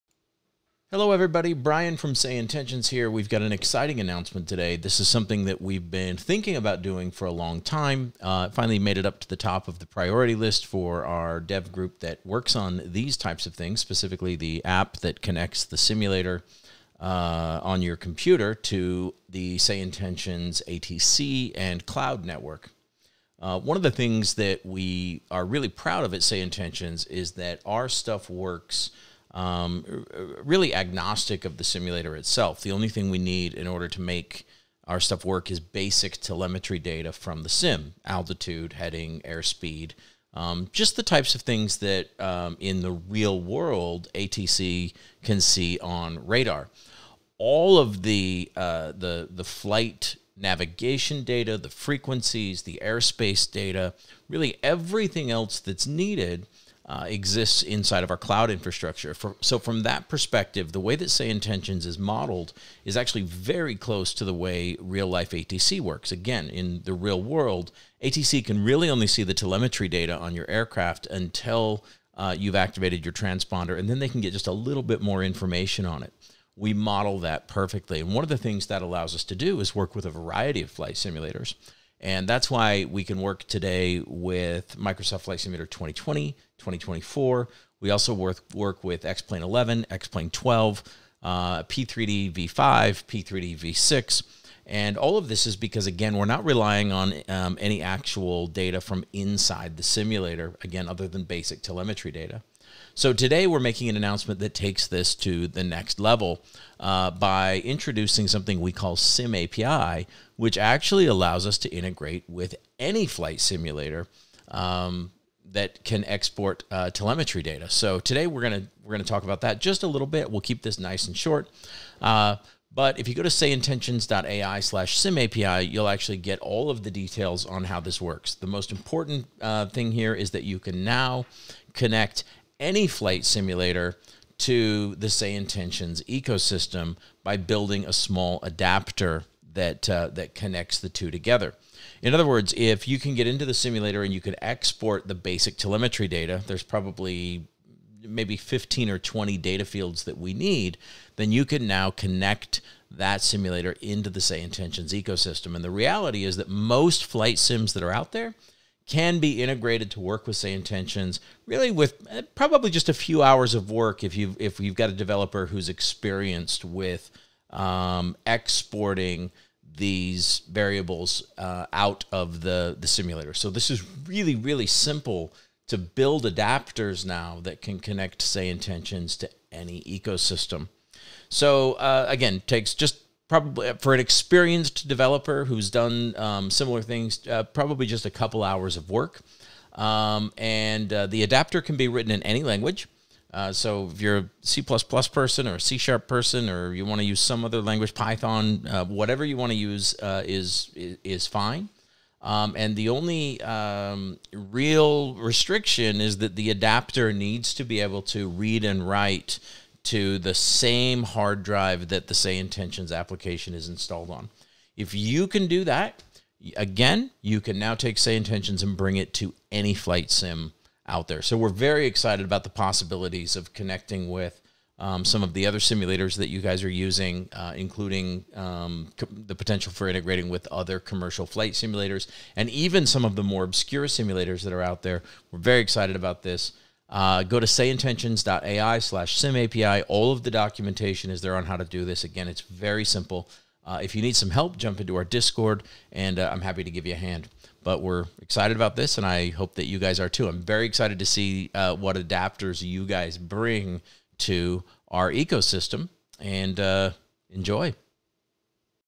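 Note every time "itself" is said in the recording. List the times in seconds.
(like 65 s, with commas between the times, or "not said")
32 s.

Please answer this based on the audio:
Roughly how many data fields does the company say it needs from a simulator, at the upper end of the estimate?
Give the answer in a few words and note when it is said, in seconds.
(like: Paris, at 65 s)
20, at 148 s.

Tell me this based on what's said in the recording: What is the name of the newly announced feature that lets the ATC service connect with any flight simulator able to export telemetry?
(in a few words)
Sim API.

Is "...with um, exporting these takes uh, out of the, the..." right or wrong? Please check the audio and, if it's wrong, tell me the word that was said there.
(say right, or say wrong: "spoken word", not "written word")
wrong: "variables", not "takes".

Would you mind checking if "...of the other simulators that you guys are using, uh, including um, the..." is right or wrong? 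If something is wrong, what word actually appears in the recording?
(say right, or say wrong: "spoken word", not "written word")
right.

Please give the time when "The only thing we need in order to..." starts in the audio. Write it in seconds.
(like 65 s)
32 s.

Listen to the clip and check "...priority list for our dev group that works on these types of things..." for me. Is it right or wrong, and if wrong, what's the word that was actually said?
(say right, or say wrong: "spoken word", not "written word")
right.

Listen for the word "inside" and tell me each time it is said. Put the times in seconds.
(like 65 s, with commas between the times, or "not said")
57 s, 99 s.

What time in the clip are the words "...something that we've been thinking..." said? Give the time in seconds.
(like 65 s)
5 s.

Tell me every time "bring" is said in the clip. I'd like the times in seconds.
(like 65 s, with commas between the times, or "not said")
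218 s, 253 s.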